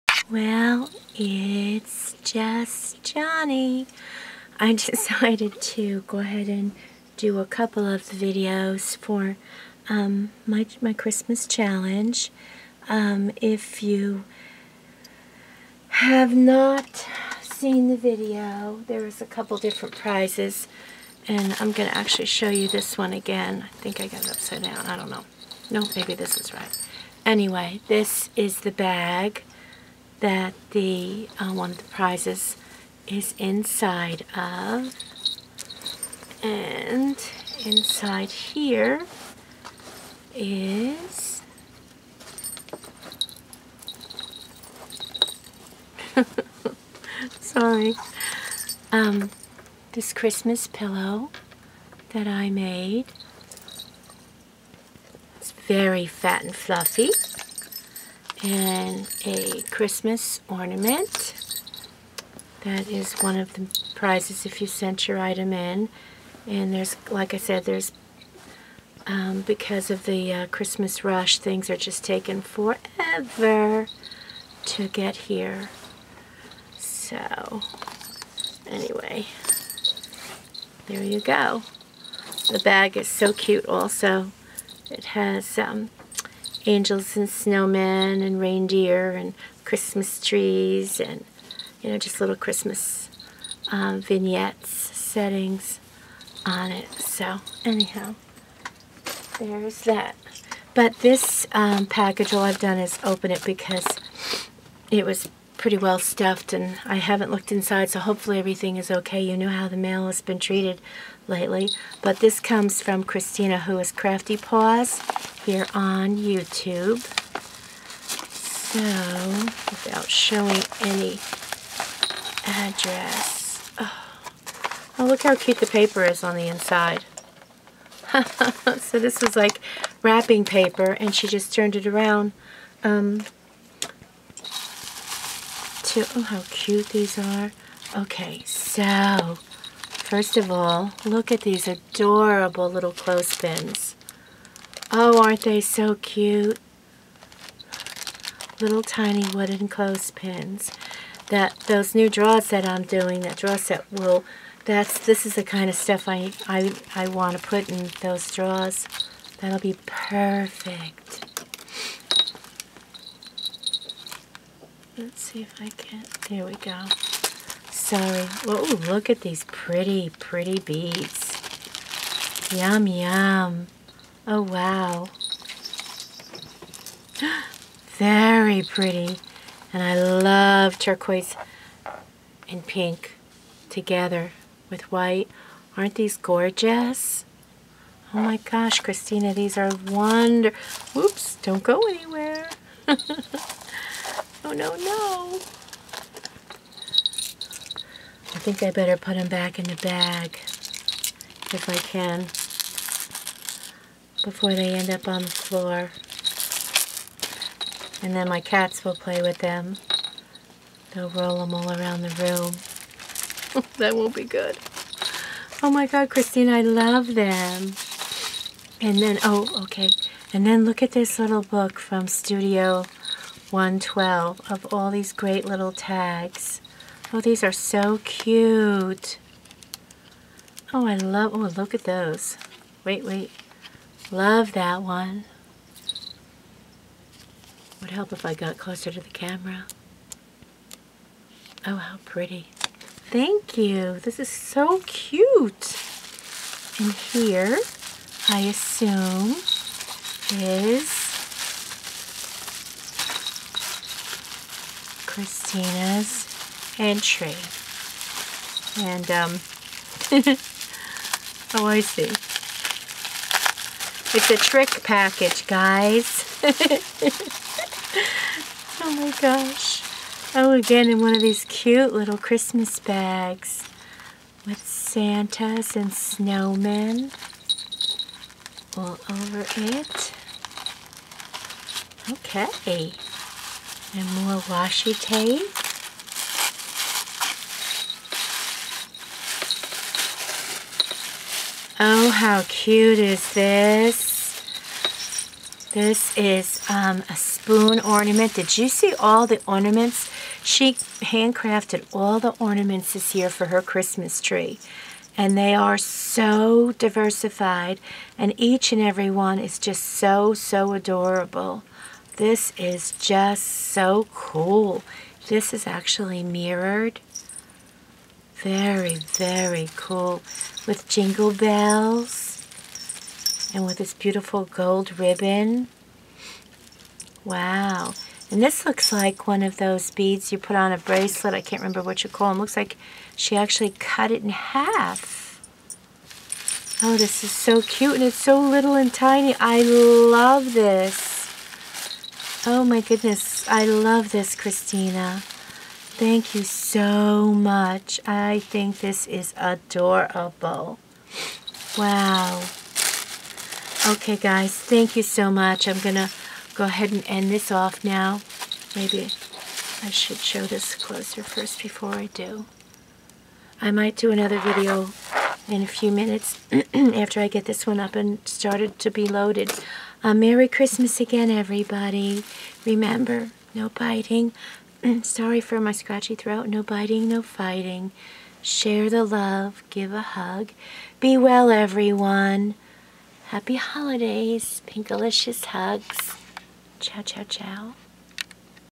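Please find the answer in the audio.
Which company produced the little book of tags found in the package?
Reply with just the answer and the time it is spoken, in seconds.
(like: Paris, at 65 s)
Studio 112, at 222 s.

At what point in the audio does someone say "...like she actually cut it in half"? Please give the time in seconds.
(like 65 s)
332 s.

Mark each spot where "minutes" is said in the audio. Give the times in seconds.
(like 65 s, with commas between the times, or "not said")
365 s.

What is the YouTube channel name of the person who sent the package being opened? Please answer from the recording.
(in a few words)
CraftyPaws.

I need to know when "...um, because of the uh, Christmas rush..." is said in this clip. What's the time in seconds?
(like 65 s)
69 s.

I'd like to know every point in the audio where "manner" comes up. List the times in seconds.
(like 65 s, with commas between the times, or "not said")
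not said.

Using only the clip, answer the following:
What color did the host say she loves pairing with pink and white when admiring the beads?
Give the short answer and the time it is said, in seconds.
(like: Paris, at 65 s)
Turquoise, at 180 s.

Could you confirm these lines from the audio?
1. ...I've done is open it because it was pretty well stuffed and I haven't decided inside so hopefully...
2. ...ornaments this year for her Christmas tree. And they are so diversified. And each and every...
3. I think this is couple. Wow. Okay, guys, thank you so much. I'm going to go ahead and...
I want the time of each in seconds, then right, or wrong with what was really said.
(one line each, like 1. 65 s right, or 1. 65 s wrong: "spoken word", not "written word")
1. 102 s wrong: "looked", not "decided"
2. 302 s right
3. 348 s wrong: "adorable", not "couple".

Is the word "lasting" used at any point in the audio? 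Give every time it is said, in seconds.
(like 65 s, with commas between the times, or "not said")
not said.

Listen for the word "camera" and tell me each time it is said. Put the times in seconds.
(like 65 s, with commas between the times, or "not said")
239 s.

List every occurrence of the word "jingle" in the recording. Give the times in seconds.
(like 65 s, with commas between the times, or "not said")
320 s.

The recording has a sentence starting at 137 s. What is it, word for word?
Okay, so first of all, look at these adorable little clothespins.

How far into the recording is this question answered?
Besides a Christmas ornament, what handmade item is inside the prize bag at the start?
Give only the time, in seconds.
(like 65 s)
50 s.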